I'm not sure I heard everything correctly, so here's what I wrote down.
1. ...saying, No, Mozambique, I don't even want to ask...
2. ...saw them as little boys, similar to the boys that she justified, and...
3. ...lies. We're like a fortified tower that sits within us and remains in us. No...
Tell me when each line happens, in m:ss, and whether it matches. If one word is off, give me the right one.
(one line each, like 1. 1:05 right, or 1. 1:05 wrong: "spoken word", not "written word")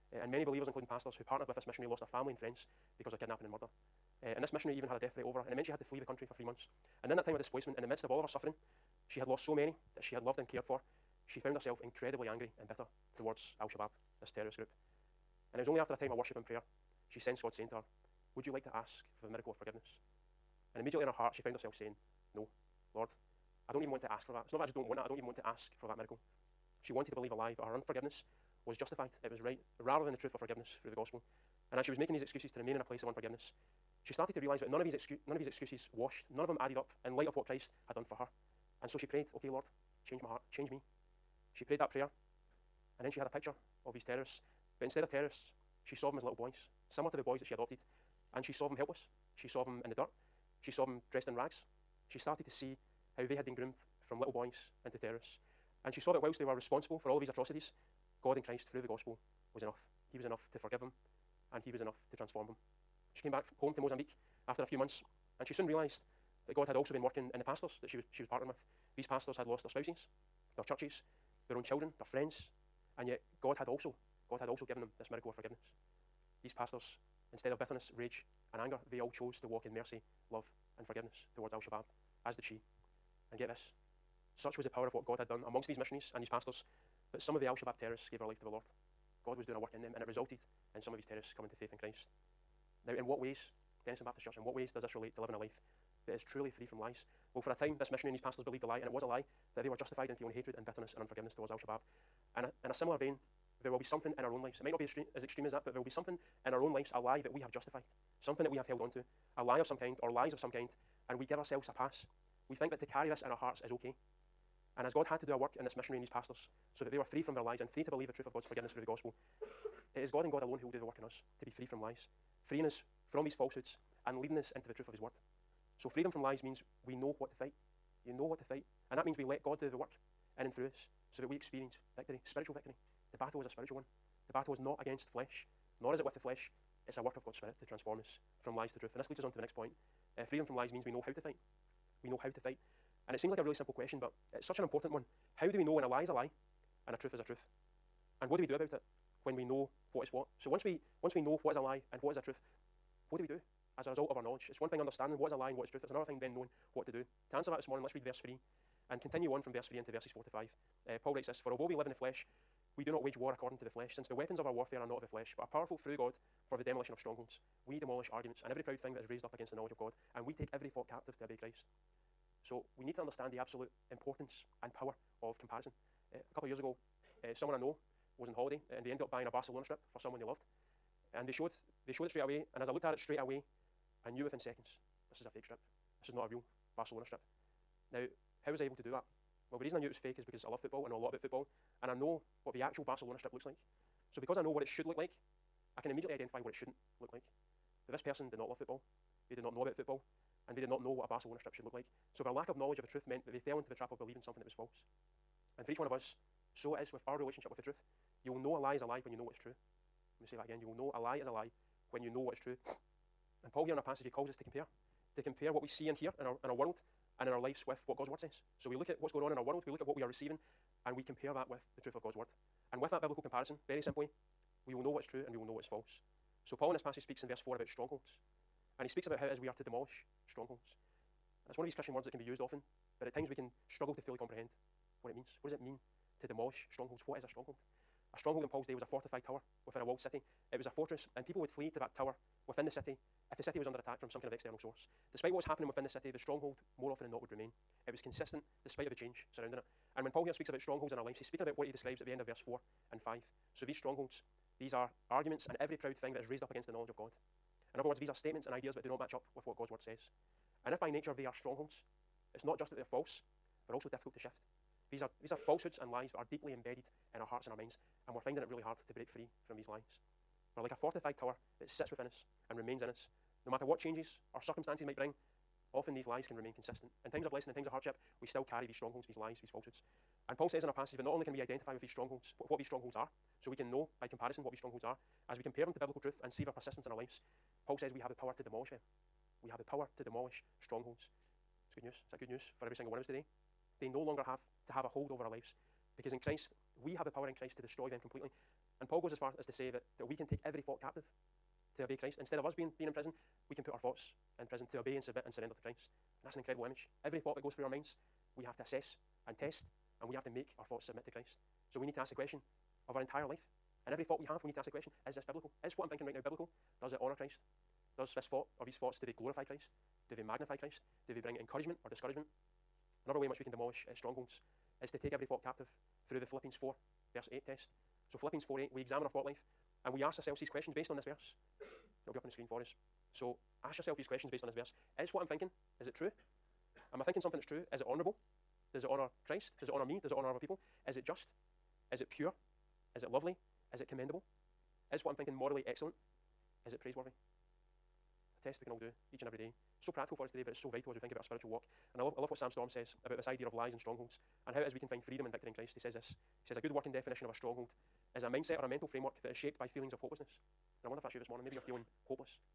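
1. 0:21 wrong: "Lord", not "Mozambique"
2. 0:45 wrong: "adopted", not "justified"
3. 4:29 right.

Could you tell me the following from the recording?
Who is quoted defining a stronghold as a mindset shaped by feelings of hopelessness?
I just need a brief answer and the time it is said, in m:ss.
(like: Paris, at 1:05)
Sam Storms, at 5:52.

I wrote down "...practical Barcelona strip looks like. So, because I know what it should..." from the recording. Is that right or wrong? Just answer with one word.
wrong.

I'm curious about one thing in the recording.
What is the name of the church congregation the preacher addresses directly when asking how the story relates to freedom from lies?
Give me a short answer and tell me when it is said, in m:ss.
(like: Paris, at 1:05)
Dennistoun Baptist Church, at 1:33.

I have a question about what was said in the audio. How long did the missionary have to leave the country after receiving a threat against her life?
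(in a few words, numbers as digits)
3 months.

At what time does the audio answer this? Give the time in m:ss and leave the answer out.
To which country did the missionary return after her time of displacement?
1:03.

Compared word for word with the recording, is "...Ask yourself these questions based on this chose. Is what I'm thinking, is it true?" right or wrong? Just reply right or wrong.
wrong.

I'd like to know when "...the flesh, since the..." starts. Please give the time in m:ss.
2:43.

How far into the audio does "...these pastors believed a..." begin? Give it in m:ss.
1:38.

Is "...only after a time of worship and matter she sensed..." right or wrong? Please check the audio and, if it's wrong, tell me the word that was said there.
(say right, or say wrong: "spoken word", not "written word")
wrong: "prayer", not "matter".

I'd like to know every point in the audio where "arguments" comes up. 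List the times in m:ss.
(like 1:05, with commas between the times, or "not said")
2:48, 4:15.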